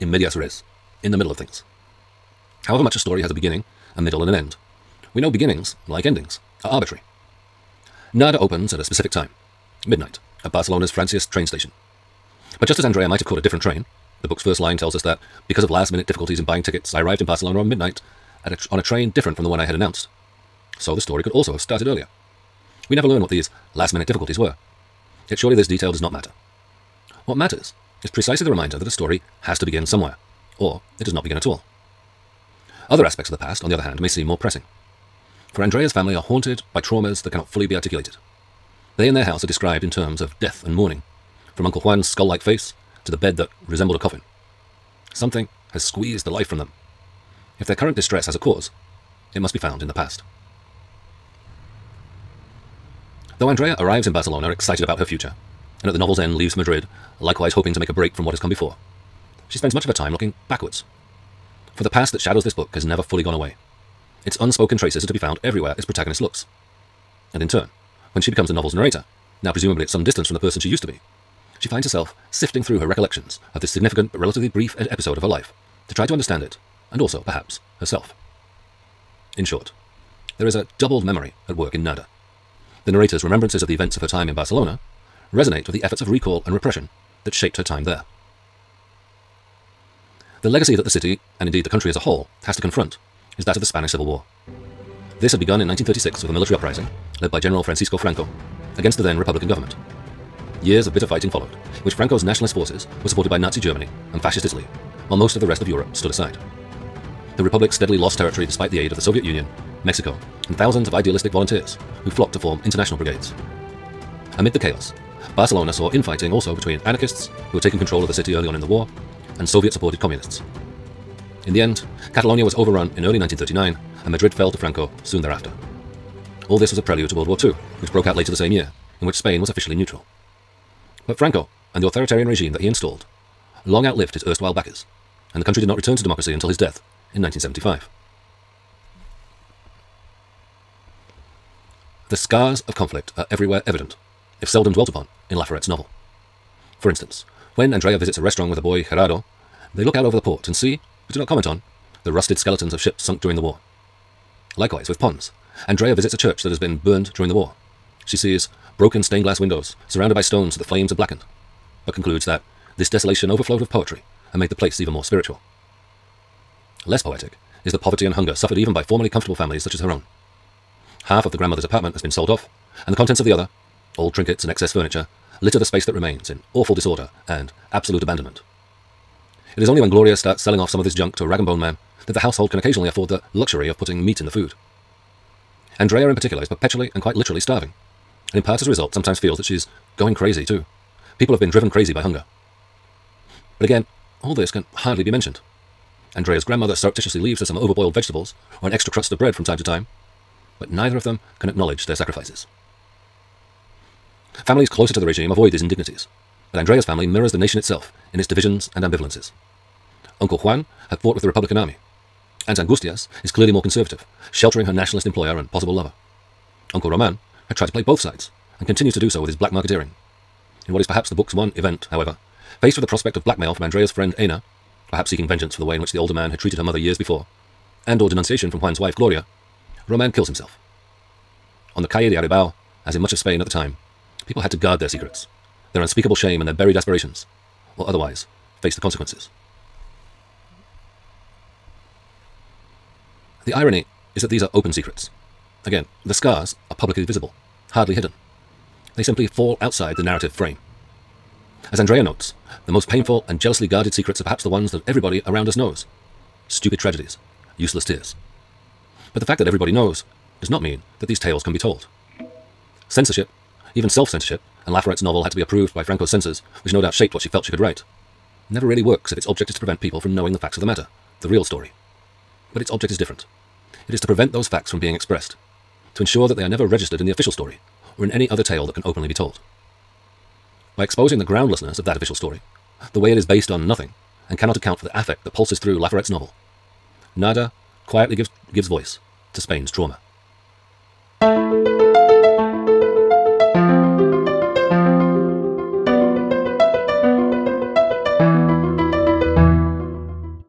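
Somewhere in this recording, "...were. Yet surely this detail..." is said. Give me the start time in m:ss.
0:24.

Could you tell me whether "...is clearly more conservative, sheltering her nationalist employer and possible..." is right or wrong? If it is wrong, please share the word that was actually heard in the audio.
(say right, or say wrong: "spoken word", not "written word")
right.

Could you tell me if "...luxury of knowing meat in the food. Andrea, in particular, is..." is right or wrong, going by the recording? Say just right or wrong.
wrong.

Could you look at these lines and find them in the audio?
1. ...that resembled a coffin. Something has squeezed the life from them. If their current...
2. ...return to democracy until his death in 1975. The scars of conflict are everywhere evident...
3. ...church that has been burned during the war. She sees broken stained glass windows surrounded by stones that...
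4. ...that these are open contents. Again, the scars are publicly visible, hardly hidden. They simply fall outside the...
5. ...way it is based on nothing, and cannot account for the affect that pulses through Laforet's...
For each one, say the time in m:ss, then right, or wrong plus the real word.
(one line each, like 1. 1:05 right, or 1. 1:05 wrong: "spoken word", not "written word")
1. 0:43 right
2. 2:15 right
3. 2:36 right
4. 4:04 wrong: "secrets", not "contents"
5. 4:42 right.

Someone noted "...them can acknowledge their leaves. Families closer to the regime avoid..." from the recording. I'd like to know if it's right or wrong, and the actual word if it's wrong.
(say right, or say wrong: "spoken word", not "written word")
wrong: "sacrifices", not "leaves".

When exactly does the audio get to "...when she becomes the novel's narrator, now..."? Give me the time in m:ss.
1:08.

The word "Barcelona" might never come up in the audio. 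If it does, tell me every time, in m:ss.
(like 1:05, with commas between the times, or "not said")
0:10, 0:17, 0:54, 1:24, 1:55.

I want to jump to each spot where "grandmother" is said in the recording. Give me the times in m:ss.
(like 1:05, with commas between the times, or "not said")
2:51, 3:16.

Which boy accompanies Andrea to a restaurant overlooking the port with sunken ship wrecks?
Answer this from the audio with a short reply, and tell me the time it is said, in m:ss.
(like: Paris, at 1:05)
Gerardo, at 2:28.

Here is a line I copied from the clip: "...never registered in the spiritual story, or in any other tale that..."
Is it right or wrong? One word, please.
wrong.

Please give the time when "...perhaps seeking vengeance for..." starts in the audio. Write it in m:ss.
3:44.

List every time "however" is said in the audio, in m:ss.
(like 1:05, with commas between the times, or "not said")
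0:02, 3:41.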